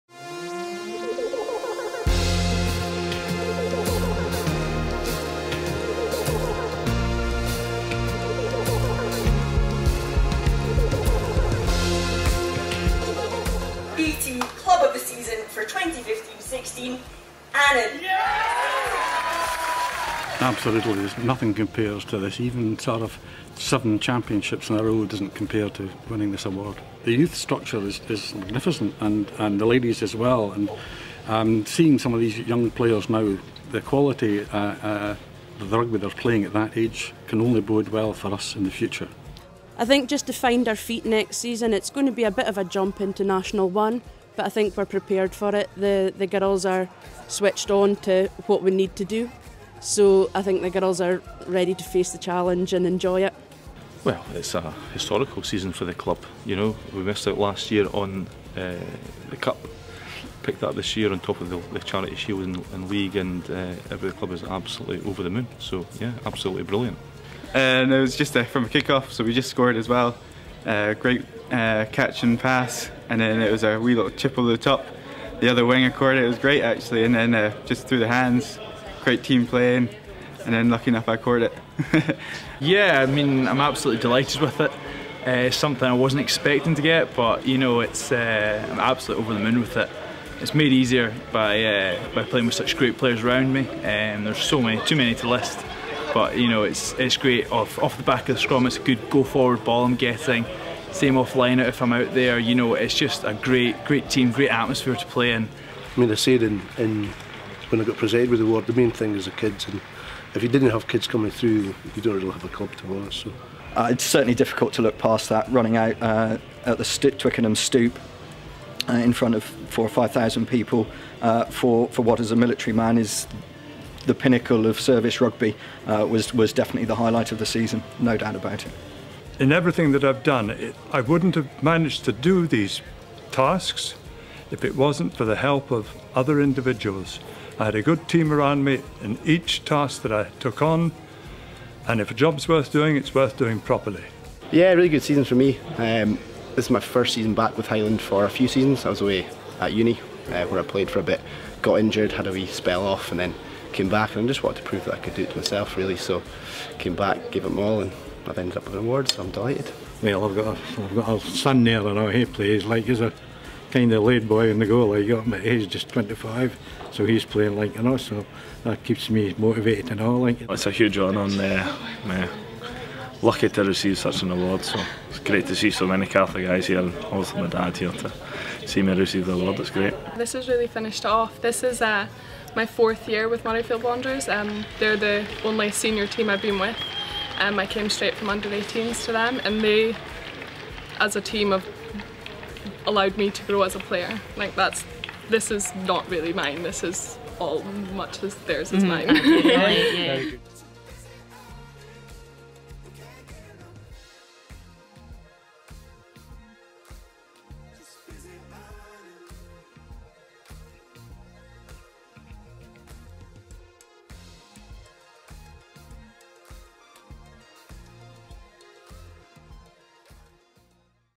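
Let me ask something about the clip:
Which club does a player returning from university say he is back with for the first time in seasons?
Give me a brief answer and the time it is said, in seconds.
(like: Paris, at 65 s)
Highland, at 147 s.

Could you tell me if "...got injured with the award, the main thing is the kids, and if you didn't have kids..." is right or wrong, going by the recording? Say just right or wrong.
wrong.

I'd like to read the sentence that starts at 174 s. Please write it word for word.
So it's great to see so many Catholic guys here, and also my dad here to see me receive the award.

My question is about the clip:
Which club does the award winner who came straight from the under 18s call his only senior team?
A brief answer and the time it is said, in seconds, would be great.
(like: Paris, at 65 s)
Murrayfield Wanderers, at 183 s.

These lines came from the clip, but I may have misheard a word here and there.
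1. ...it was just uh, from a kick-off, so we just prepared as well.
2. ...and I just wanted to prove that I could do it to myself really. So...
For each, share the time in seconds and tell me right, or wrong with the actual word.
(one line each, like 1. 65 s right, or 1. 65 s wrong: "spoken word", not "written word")
1. 67 s wrong: "scored", not "prepared"
2. 154 s right.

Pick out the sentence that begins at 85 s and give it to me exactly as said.
Uh, something I wasn't expecting to get, but you know, it's uh, I'm absolutely over the moon with it.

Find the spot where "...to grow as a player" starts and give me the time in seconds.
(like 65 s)
193 s.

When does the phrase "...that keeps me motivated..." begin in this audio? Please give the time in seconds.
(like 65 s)
168 s.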